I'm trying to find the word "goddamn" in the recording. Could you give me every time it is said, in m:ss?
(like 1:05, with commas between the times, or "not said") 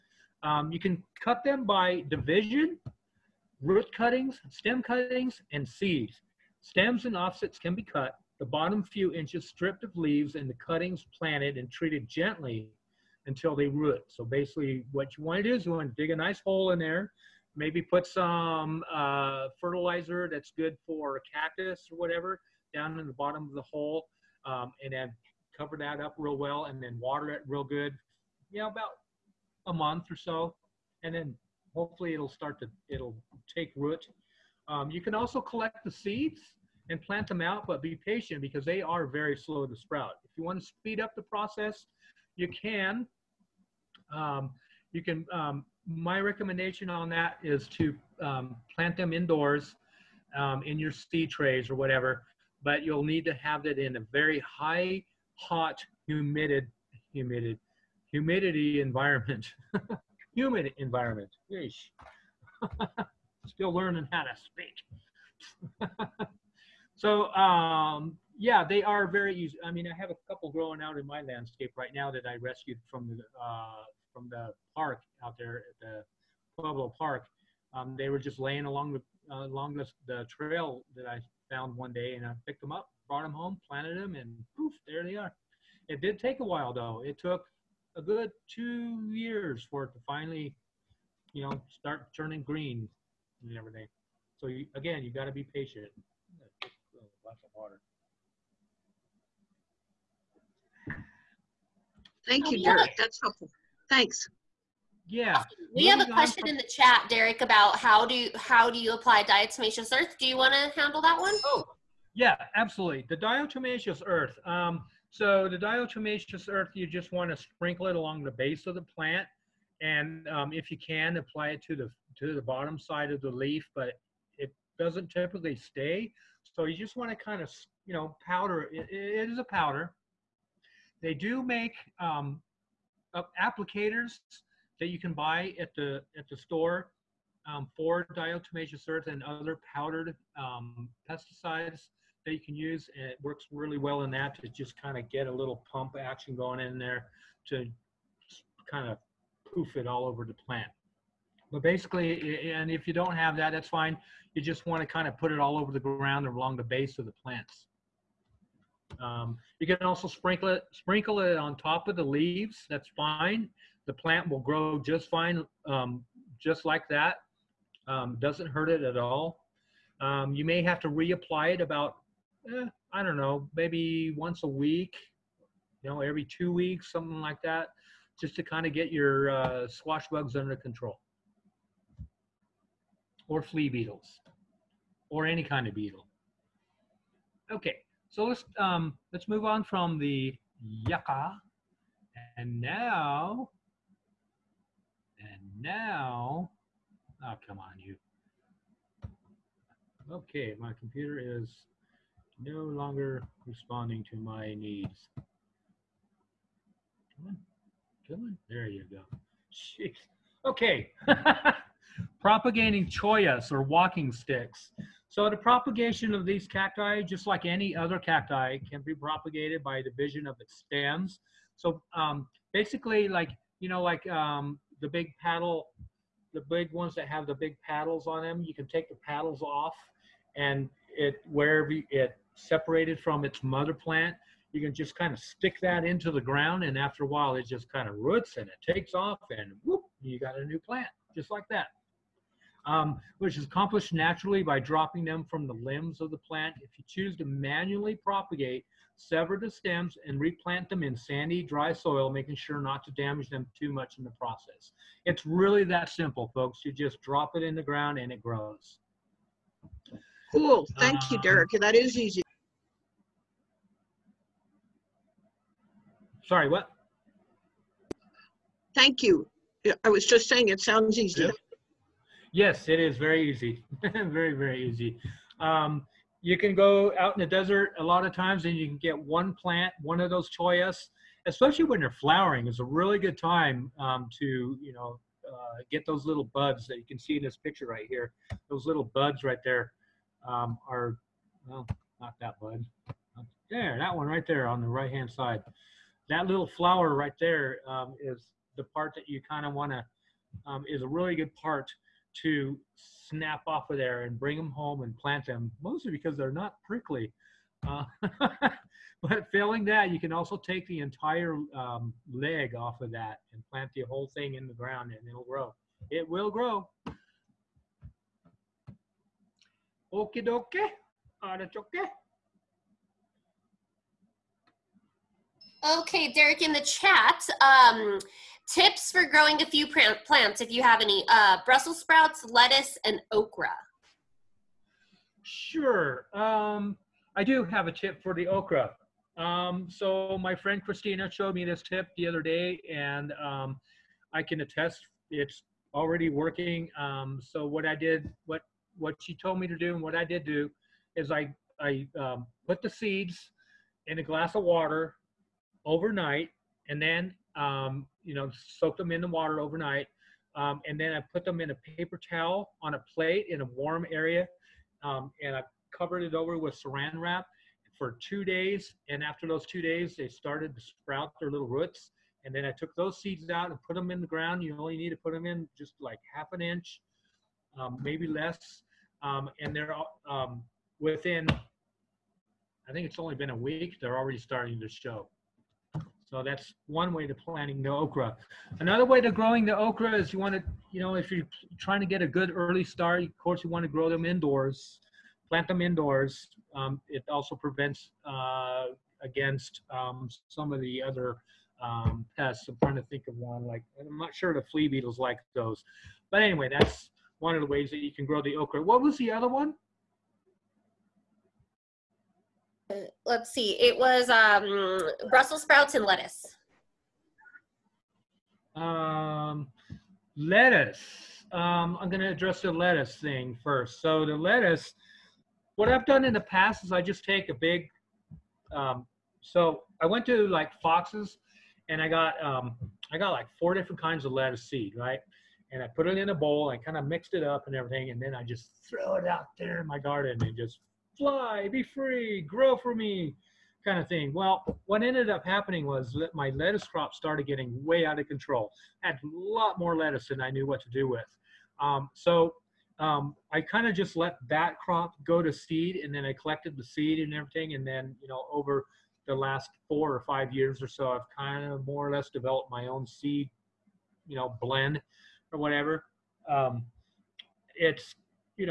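not said.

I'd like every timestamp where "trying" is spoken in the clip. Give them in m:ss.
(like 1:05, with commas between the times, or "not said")
6:31, 6:42.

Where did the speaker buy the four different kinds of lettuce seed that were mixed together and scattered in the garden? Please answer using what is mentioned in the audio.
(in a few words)
Fox's.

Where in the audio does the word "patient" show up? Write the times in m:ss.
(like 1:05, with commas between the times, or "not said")
0:37, 1:35.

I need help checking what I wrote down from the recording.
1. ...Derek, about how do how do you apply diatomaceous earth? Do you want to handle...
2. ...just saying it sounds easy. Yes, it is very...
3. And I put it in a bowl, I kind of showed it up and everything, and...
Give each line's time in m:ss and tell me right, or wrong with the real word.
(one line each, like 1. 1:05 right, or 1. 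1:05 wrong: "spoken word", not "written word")
1. 1:47 right
2. 4:30 right
3. 7:15 wrong: "mixed", not "showed".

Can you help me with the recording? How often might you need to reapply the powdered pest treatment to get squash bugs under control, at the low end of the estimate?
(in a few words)
Once a week.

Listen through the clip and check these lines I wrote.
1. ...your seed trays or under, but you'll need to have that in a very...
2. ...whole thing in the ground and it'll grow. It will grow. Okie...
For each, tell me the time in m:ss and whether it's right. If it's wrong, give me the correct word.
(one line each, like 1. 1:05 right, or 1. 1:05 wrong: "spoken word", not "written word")
1. 0:50 wrong: "whatever", not "under"
2. 5:13 right.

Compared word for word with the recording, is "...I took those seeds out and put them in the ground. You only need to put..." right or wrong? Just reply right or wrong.
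right.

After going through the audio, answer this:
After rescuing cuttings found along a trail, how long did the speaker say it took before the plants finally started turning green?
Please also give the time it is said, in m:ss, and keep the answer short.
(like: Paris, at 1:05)
2 years, at 1:27.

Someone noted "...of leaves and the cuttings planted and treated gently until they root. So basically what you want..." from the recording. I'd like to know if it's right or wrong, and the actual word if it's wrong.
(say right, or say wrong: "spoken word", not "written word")
right.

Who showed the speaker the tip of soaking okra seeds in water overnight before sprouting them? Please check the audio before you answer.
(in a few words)
Christina.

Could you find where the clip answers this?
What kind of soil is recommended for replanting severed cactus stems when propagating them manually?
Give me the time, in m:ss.
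4:10.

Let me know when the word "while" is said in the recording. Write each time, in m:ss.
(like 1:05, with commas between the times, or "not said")
1:26, 3:57.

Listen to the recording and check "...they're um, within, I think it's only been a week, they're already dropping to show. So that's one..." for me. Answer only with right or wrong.
wrong.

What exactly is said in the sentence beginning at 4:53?
There, that one right there on the right-hand side.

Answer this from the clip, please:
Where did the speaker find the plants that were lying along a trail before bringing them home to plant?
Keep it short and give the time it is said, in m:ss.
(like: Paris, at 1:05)
Pueblo Park, at 1:16.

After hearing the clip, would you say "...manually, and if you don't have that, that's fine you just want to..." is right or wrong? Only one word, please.
wrong.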